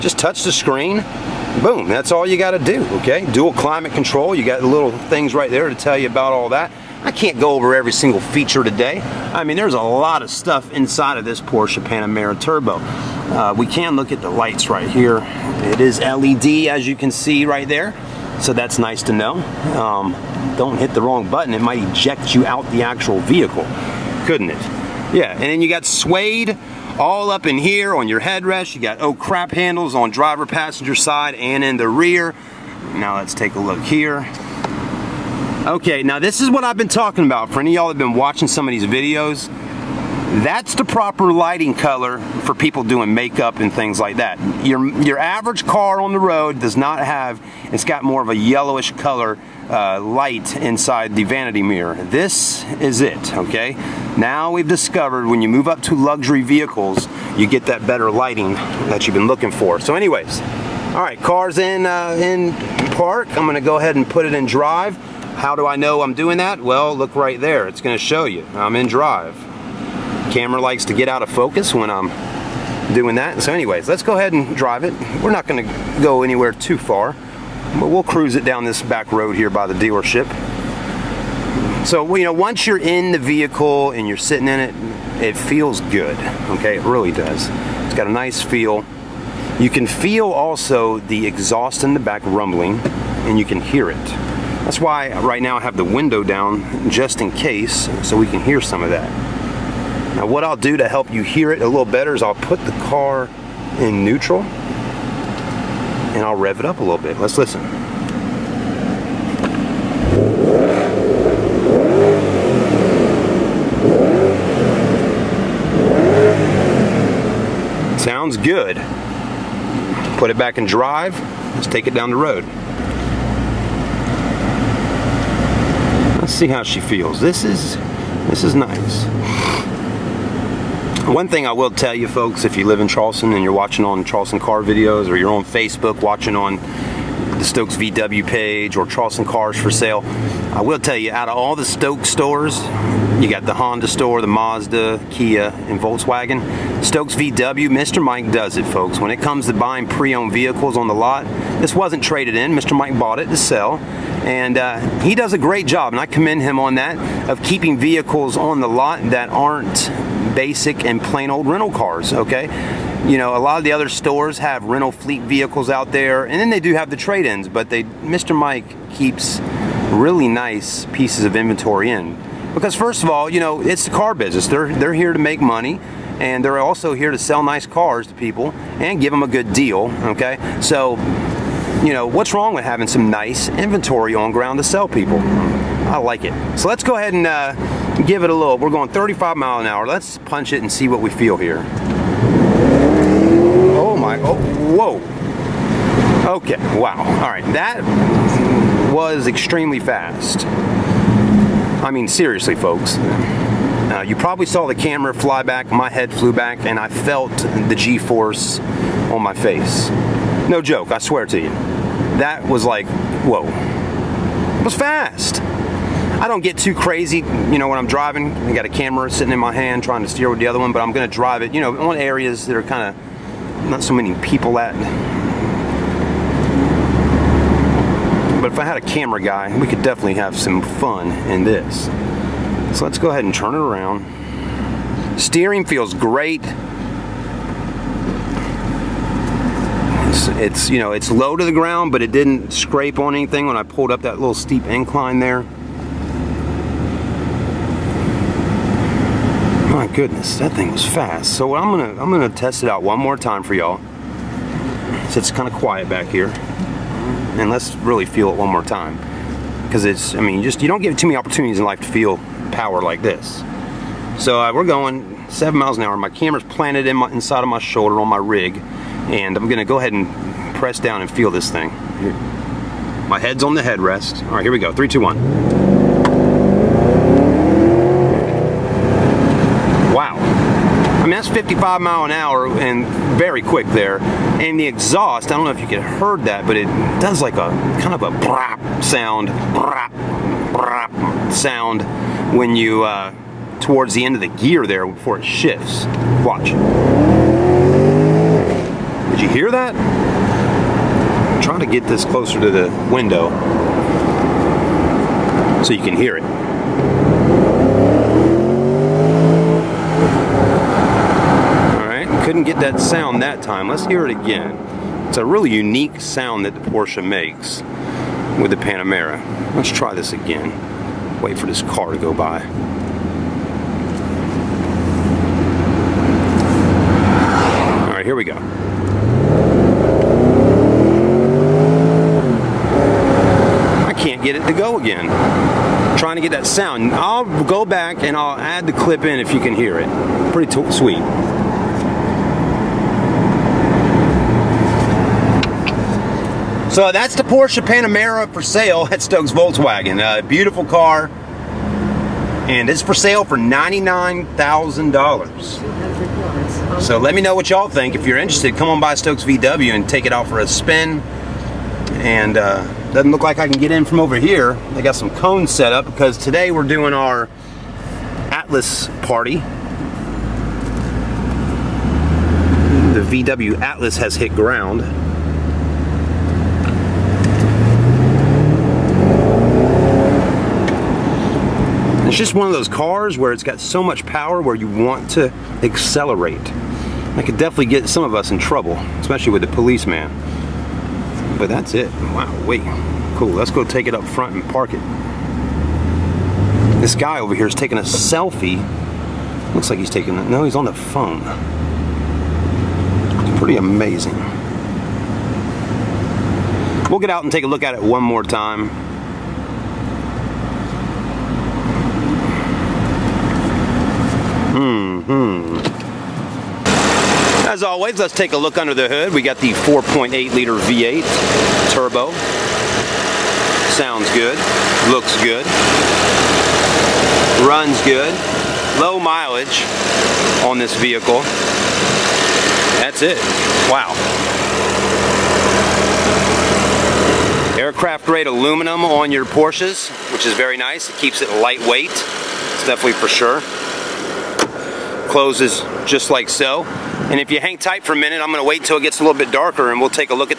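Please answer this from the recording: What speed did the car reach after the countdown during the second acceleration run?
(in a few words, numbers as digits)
55 mph.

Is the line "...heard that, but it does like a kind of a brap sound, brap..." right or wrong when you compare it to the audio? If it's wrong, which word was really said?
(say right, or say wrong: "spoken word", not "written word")
right.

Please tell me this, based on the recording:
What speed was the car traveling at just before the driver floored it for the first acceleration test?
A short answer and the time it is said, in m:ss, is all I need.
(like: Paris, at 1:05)
35 mph, at 3:08.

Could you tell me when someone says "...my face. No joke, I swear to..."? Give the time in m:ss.
3:29.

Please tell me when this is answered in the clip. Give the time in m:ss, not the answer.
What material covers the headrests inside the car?
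0:25.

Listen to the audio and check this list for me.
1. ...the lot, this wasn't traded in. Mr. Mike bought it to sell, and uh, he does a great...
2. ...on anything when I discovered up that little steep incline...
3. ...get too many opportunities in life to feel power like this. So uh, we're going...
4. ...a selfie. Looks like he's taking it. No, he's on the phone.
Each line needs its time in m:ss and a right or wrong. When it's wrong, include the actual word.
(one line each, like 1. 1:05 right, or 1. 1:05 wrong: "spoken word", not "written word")
1. 2:30 right
2. 4:02 wrong: "pulled", not "discovered"
3. 4:20 right
4. 6:37 right.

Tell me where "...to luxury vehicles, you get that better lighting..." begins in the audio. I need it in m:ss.
0:55.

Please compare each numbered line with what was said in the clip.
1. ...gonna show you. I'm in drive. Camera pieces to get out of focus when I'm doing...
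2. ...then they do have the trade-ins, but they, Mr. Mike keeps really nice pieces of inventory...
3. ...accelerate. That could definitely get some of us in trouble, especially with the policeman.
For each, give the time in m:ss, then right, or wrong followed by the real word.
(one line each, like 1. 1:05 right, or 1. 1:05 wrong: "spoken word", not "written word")
1. 1:07 wrong: "likes", not "pieces"
2. 2:46 right
3. 6:25 right.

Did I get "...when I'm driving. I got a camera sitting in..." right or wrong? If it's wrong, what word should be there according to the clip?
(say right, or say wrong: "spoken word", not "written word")
right.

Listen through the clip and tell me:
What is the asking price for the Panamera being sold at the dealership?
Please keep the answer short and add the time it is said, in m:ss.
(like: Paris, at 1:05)
$99,000, at 5:53.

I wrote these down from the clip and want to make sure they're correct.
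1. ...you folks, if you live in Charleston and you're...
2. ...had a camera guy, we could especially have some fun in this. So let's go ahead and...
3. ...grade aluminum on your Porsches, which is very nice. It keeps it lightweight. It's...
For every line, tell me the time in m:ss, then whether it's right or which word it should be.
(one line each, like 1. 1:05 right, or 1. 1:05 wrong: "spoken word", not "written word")
1. 2:11 right
2. 3:48 wrong: "definitely", not "especially"
3. 7:18 right.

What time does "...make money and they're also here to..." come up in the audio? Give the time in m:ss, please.
2:55.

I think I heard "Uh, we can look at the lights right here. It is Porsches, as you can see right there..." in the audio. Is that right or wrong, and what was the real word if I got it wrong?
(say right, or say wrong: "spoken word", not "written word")
wrong: "LED", not "Porsches".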